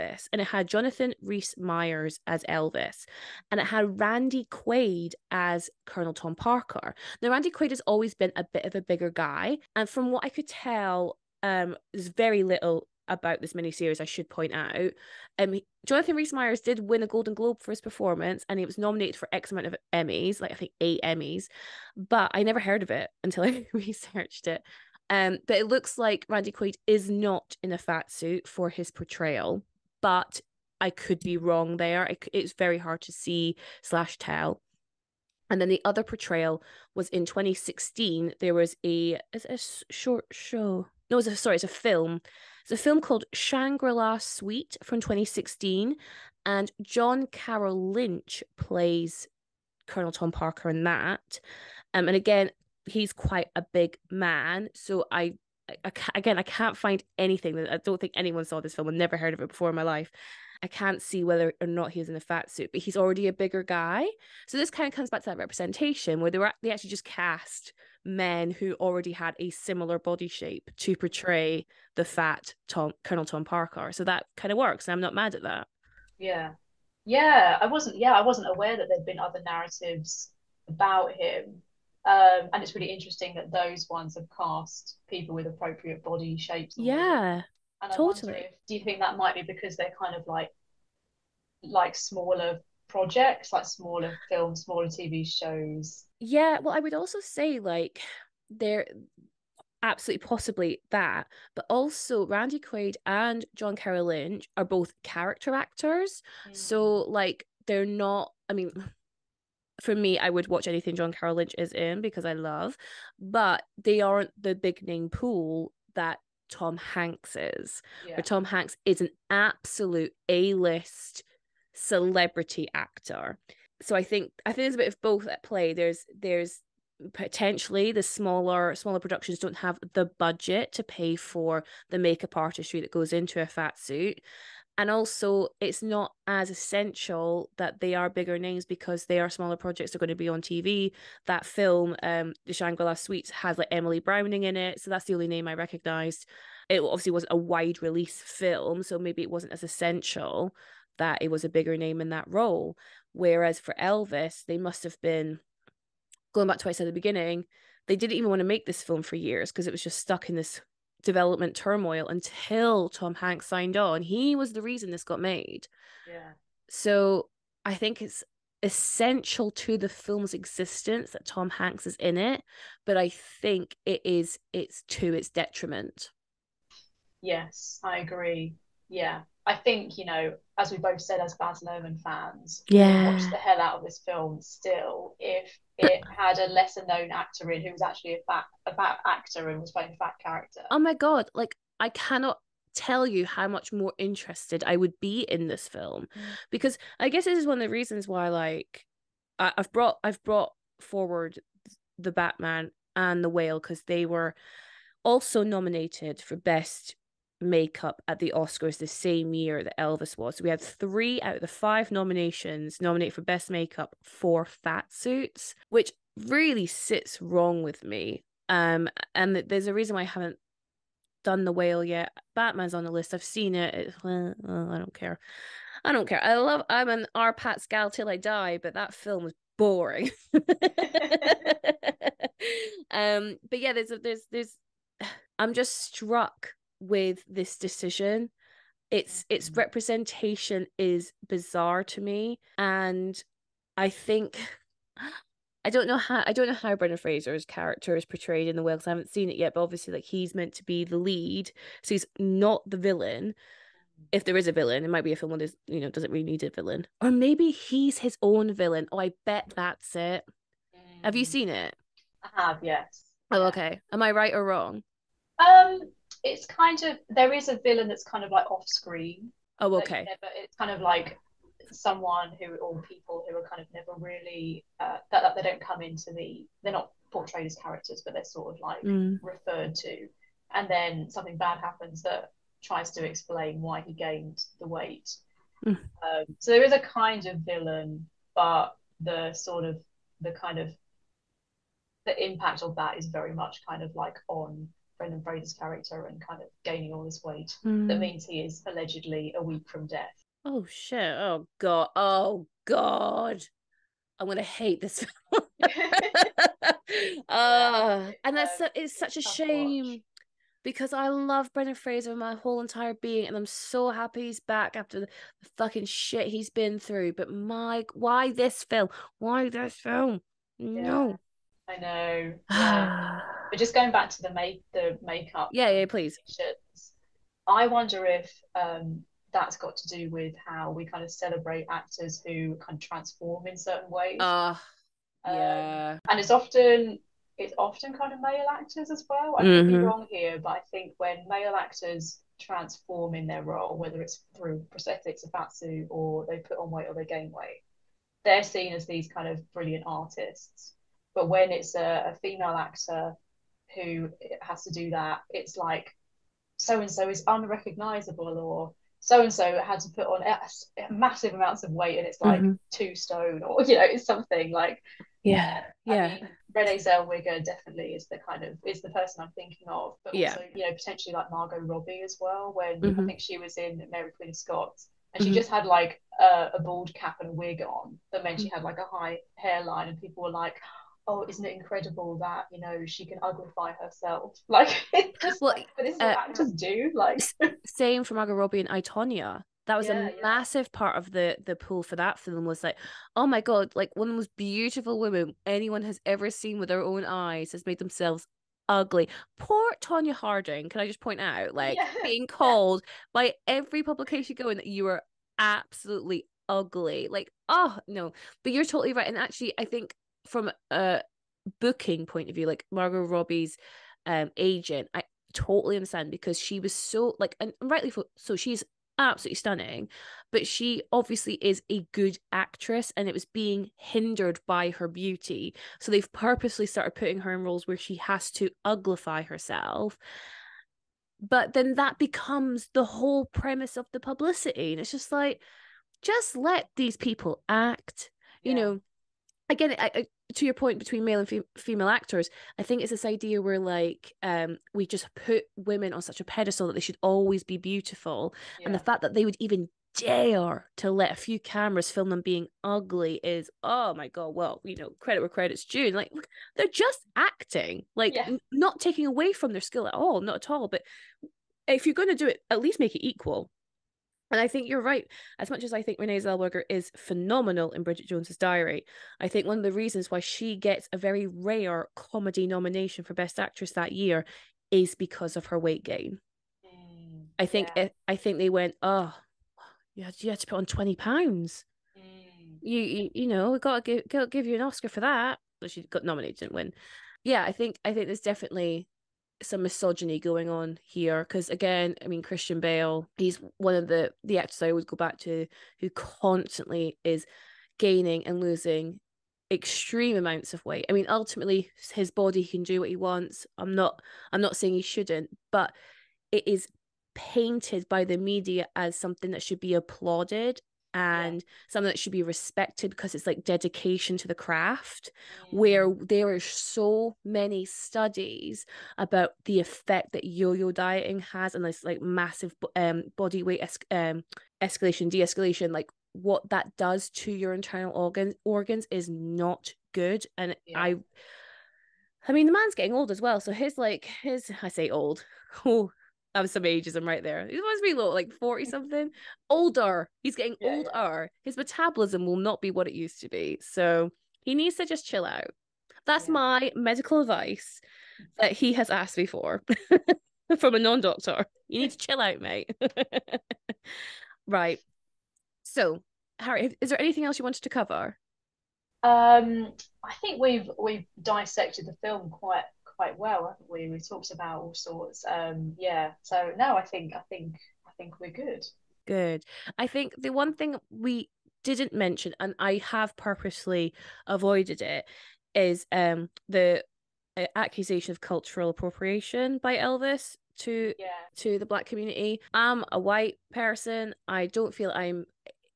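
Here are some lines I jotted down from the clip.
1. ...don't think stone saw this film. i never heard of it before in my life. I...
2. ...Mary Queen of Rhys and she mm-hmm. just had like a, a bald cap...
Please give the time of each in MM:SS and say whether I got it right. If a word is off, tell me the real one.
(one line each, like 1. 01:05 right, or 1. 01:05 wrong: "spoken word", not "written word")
1. 00:57 wrong: "anyone", not "stone"
2. 06:13 wrong: "Scots", not "Rhys".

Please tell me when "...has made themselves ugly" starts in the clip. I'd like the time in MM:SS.
06:37.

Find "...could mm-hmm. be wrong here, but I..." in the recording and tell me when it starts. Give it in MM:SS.
05:39.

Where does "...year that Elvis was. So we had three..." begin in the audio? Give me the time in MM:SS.
03:29.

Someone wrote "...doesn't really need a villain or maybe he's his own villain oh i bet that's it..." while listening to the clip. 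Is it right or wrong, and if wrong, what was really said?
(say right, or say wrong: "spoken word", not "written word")
right.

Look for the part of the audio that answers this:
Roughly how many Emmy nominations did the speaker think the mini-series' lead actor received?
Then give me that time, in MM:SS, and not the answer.
00:20.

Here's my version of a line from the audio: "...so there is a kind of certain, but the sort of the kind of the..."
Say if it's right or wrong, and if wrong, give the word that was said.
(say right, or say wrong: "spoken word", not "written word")
wrong: "villain", not "certain".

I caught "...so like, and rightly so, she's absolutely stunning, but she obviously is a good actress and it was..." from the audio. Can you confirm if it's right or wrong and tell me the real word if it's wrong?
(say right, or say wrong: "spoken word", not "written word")
right.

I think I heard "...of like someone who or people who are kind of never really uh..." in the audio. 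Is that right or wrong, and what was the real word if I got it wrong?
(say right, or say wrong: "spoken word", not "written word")
right.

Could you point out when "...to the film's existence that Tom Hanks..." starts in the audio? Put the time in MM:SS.
02:49.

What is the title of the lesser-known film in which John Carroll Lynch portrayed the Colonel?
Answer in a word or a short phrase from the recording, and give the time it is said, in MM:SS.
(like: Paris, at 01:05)
Shangri La Suite, at 00:43.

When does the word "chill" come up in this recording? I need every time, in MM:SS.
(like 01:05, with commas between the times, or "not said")
09:05, 09:11.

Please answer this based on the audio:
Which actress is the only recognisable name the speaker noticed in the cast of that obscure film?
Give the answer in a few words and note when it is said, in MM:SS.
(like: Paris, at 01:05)
Emily Browning, at 02:23.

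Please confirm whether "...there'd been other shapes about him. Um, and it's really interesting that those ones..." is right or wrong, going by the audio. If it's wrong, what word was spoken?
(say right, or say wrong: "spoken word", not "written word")
wrong: "narratives", not "shapes".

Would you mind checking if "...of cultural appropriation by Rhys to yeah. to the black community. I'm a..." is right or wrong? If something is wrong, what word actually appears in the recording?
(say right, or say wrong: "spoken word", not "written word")
wrong: "Elvis", not "Rhys".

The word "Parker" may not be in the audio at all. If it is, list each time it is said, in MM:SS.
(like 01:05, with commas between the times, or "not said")
00:06, 00:50, 01:13.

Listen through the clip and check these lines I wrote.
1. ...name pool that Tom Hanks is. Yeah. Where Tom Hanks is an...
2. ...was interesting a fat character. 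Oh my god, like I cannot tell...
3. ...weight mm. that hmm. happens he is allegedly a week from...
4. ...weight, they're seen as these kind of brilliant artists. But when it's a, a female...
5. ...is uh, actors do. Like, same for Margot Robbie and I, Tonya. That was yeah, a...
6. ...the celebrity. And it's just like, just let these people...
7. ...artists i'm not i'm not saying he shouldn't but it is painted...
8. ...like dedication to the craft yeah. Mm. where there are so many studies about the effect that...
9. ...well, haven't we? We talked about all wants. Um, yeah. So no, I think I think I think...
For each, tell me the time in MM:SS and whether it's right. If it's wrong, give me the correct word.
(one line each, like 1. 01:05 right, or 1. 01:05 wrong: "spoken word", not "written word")
1. 01:54 right
2. 03:09 wrong: "playing", not "interesting"
3. 04:57 wrong: "means", not "happens"
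4. 05:47 right
5. 06:25 right
6. 07:13 wrong: "publicity", not "celebrity"
7. 08:22 wrong: "wants", not "artists"
8. 08:33 right
9. 09:23 wrong: "sorts", not "wants".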